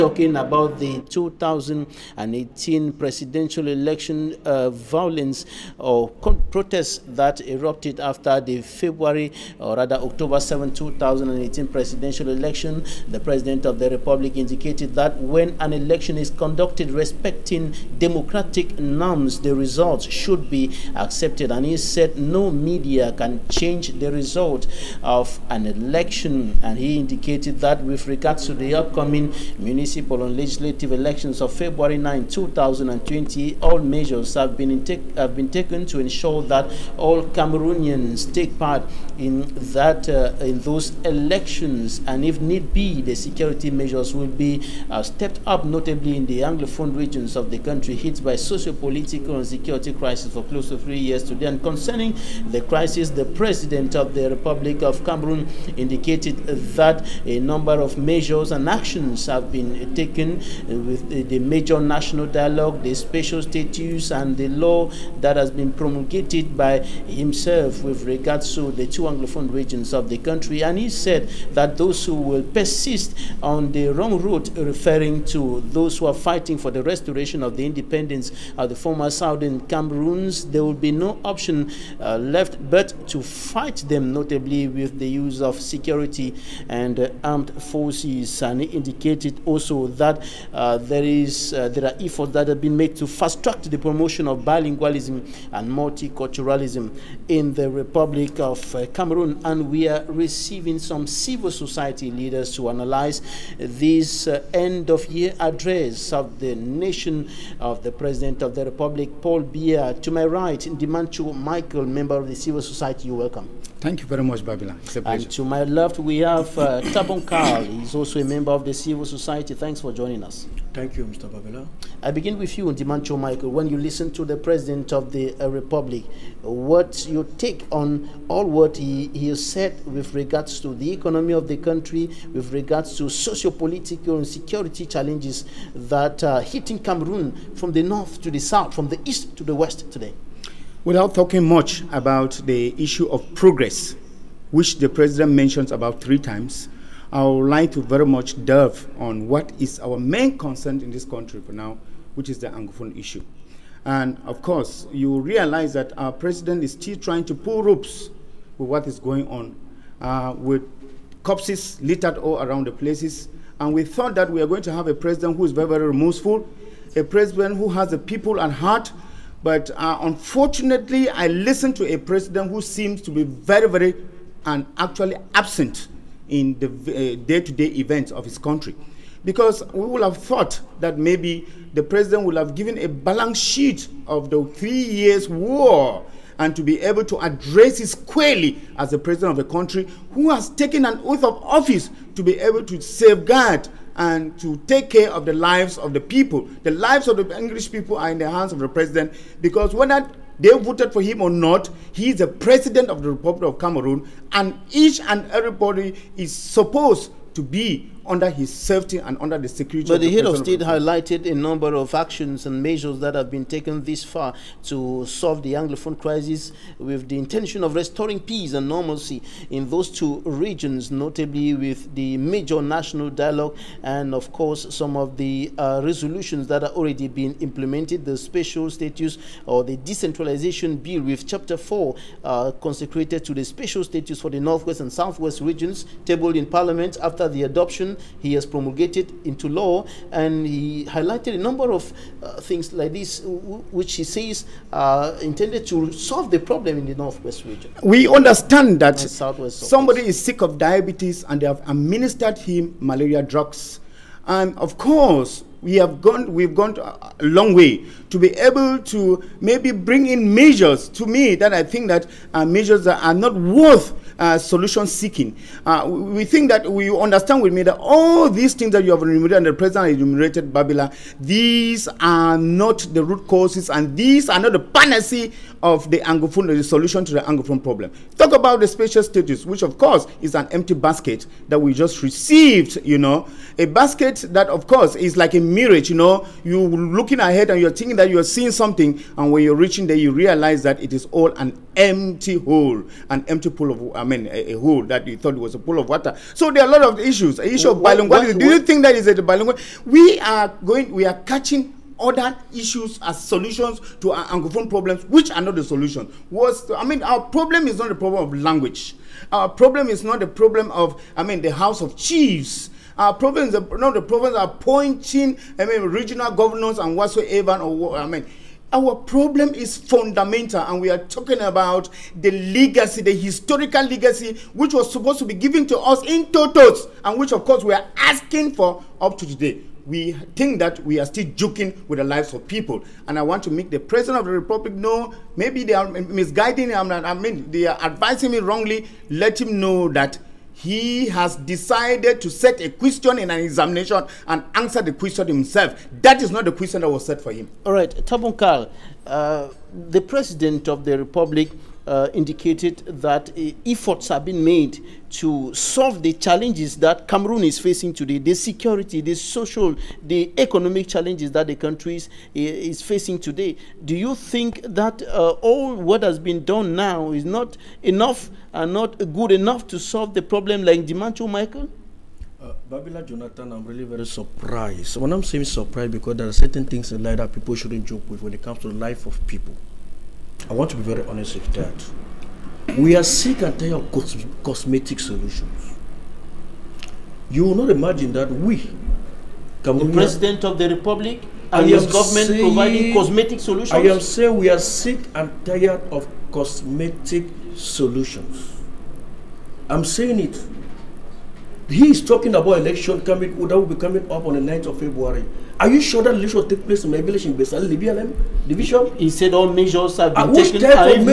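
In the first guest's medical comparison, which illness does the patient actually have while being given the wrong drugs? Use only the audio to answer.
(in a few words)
Diabetes.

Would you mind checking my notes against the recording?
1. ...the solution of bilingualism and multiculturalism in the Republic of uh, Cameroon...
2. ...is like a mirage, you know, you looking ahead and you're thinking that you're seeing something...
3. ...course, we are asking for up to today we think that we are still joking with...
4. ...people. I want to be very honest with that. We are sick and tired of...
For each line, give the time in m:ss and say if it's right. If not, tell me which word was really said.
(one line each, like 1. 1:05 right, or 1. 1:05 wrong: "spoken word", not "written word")
1. 1:33 wrong: "promotion", not "solution"
2. 4:44 right
3. 5:27 right
4. 6:19 right.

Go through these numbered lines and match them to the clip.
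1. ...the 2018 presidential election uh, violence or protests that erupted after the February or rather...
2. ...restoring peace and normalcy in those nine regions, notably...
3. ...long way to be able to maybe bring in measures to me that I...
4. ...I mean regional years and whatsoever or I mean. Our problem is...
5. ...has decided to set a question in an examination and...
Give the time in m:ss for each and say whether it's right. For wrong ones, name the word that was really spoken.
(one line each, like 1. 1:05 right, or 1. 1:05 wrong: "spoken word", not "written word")
1. 0:00 right
2. 3:37 wrong: "two", not "nine"
3. 4:17 right
4. 5:15 wrong: "governors", not "years"
5. 5:41 right.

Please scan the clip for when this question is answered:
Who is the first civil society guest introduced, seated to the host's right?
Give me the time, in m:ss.
1:50.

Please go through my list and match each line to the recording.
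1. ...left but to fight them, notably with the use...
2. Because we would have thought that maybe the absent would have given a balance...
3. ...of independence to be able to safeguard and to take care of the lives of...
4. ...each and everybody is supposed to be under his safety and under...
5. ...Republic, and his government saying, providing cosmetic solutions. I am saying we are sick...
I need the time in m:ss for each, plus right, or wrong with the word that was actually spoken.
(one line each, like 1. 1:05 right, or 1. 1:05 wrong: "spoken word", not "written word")
1. 1:22 right
2. 2:59 wrong: "president", not "absent"
3. 3:11 wrong: "office", not "independence"
4. 3:24 right
5. 6:30 right.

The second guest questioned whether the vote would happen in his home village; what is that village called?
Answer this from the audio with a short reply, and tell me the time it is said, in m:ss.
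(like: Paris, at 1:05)
Besal, at 6:47.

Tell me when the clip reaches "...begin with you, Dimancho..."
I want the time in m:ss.
2:02.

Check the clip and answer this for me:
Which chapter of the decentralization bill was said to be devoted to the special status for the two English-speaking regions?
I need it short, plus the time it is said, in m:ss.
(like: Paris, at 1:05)
Chapter 4, at 3:51.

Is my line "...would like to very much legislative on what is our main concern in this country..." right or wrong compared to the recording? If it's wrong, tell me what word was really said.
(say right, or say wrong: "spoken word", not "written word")
wrong: "delve", not "legislative".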